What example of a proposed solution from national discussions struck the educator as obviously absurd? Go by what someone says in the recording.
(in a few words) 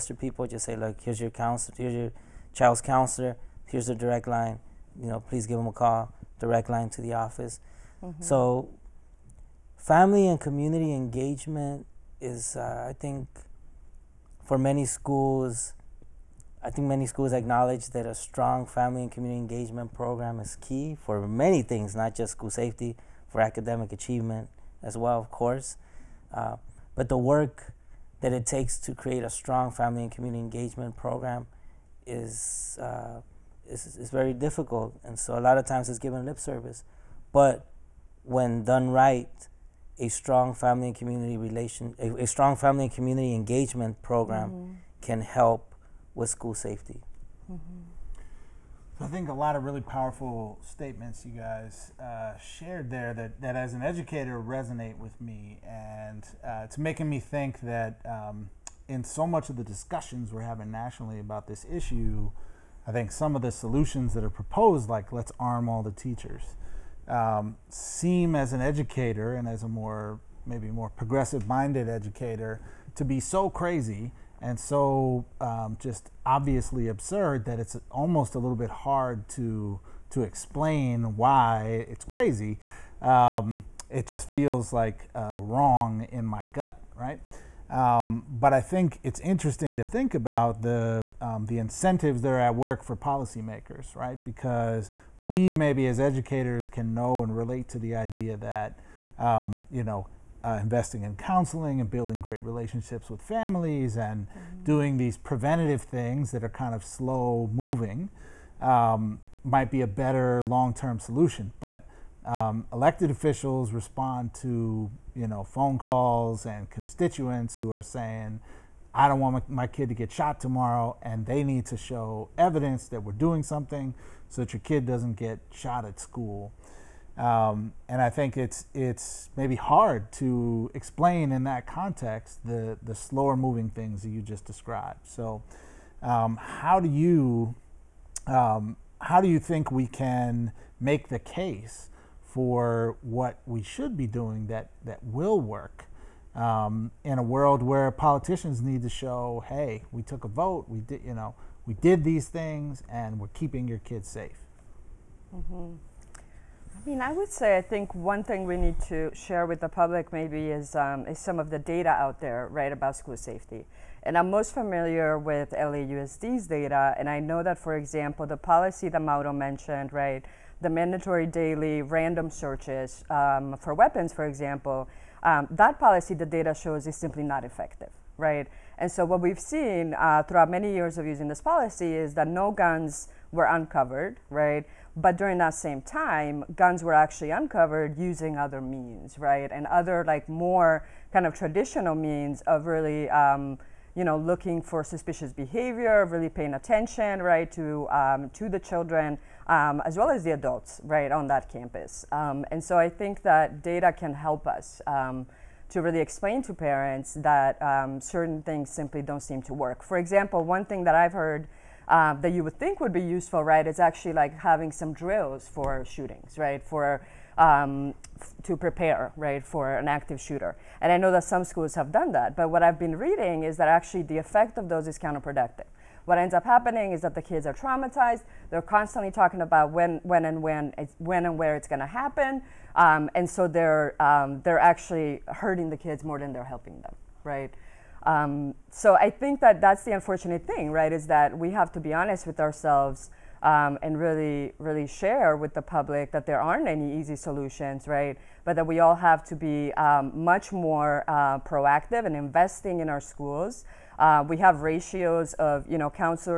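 arm all the teachers.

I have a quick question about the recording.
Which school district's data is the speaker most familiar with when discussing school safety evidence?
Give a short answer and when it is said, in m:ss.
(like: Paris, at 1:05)
LAUSD, at 2:45.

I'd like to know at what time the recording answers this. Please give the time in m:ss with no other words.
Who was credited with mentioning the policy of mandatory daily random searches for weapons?
2:49.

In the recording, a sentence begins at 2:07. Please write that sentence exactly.
Um, and I think it's it's maybe hard to explain in that context the the slower moving things that you just described.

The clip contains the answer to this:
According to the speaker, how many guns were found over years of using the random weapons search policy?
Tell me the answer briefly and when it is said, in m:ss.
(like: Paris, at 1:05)
0, at 3:02.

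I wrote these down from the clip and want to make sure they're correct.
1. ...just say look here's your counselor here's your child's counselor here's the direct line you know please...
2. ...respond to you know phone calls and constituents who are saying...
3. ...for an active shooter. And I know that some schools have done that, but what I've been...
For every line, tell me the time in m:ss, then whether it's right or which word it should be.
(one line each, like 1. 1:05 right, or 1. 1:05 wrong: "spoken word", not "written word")
1. 0:00 right
2. 1:53 right
3. 3:39 right.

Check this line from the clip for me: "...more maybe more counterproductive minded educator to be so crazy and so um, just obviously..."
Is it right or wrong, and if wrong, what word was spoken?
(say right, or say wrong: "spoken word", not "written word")
wrong: "progressive", not "counterproductive".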